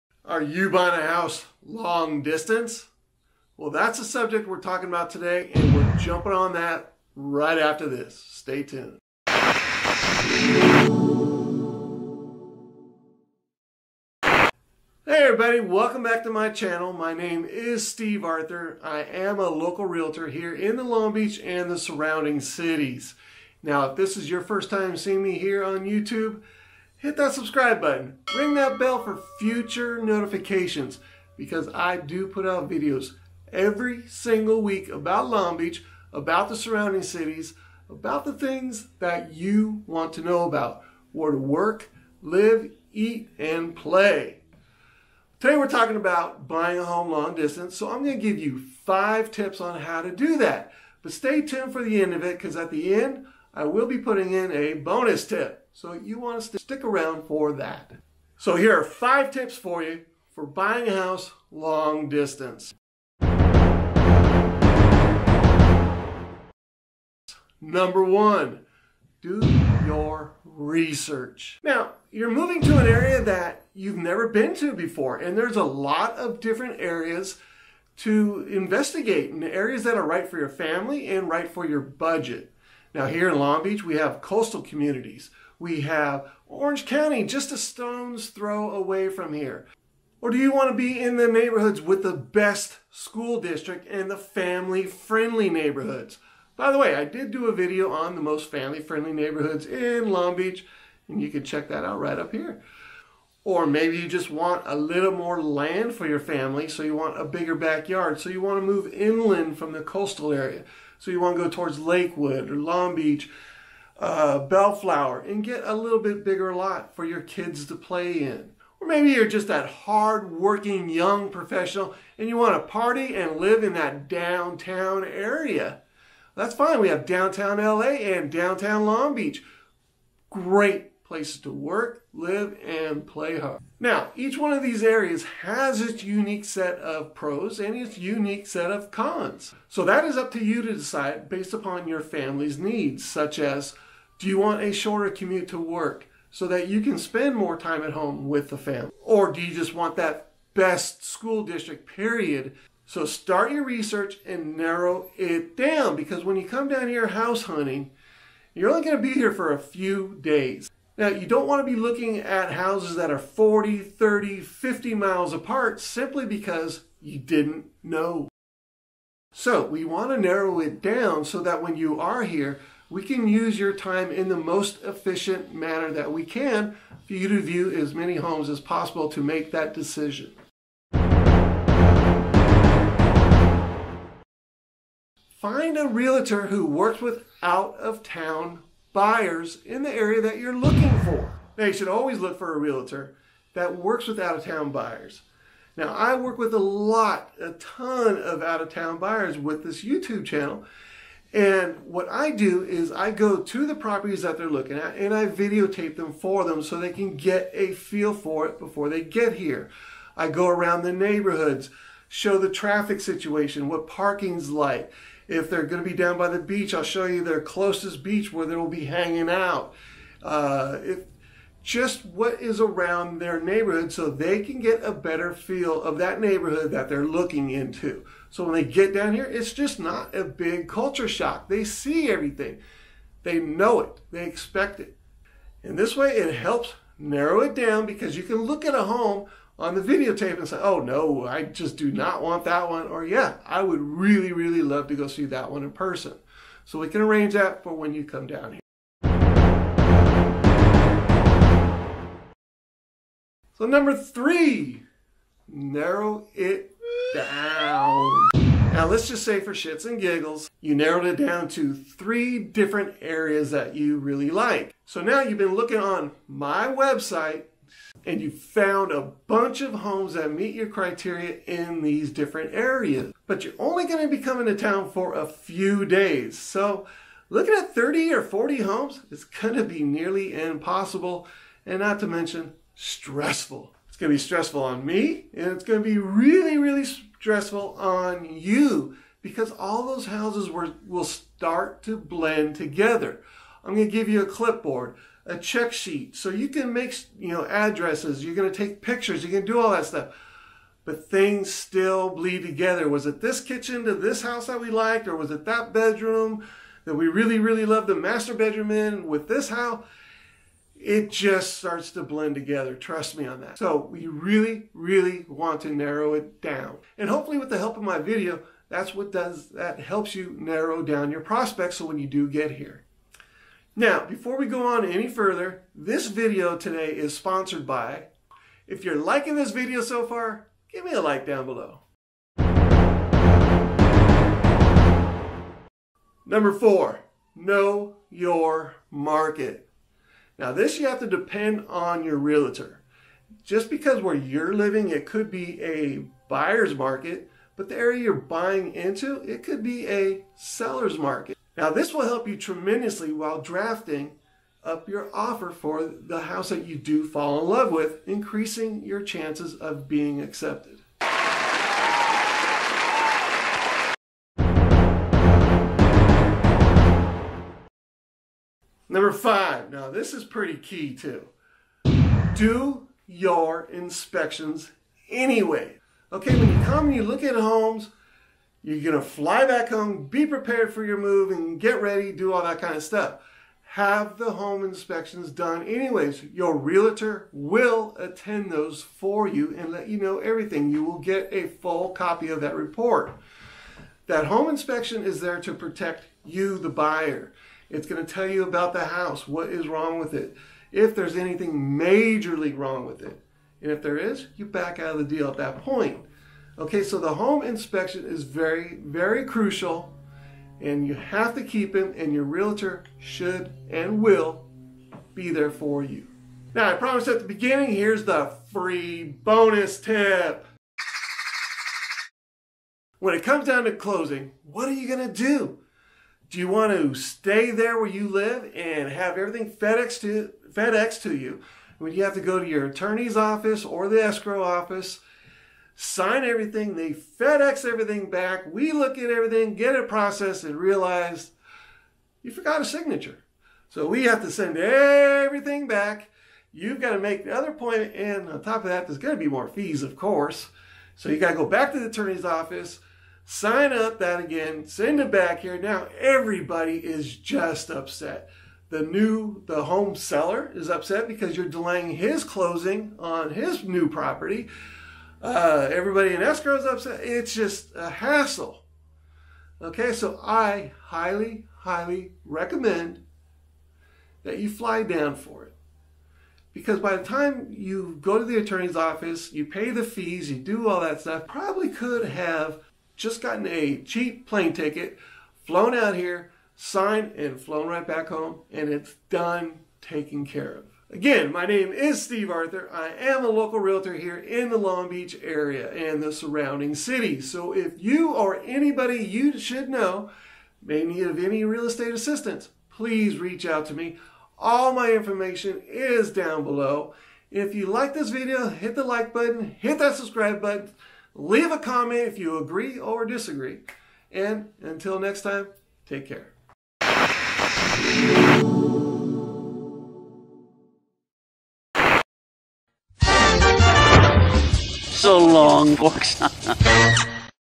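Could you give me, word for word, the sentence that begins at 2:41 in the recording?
Now, you don't want to be looking at houses that are 40, 30, 50 miles apart simply because you didn't know.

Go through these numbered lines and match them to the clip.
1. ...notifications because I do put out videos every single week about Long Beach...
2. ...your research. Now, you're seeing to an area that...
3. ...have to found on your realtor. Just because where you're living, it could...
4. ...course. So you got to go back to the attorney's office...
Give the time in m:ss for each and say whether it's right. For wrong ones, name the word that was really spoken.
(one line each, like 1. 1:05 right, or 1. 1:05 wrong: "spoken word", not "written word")
1. 0:30 right
2. 1:09 wrong: "moving", not "seeing"
3. 5:40 wrong: "depend", not "found"
4. 7:29 right.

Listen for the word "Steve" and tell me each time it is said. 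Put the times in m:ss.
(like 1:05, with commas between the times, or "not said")
0:17, 8:12.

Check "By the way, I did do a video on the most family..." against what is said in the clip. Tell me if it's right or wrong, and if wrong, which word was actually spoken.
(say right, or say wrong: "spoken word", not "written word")
right.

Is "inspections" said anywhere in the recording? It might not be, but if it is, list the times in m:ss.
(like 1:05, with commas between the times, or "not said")
6:13, 6:24, 6:34, 6:47.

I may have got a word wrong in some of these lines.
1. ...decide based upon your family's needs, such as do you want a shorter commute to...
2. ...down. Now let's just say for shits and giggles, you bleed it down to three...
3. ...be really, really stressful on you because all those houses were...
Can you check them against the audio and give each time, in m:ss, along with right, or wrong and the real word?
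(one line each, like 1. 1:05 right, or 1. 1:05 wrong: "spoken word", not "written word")
1. 2:20 right
2. 4:17 wrong: "narrowed", not "bleed"
3. 4:45 right.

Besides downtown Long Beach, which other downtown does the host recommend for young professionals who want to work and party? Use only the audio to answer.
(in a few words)
Downtown LA.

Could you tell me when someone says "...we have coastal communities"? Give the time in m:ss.
1:23.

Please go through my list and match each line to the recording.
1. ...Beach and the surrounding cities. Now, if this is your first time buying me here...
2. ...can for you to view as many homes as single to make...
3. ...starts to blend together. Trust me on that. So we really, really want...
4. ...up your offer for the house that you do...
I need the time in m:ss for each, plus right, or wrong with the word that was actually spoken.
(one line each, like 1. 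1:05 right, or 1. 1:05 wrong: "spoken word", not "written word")
1. 0:21 wrong: "seeing", not "buying"
2. 2:56 wrong: "possible", not "single"
3. 5:11 right
4. 5:54 right.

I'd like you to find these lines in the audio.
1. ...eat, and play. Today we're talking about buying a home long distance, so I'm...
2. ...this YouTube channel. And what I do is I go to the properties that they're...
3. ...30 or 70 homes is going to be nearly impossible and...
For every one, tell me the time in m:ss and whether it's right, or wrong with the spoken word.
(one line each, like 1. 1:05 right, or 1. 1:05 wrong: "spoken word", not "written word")
1. 0:42 right
2. 3:19 right
3. 4:37 wrong: "40", not "70".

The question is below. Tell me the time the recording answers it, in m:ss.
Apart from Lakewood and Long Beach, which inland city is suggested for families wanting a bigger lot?
1:54.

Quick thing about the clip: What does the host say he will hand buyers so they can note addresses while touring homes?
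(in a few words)
A clipboard.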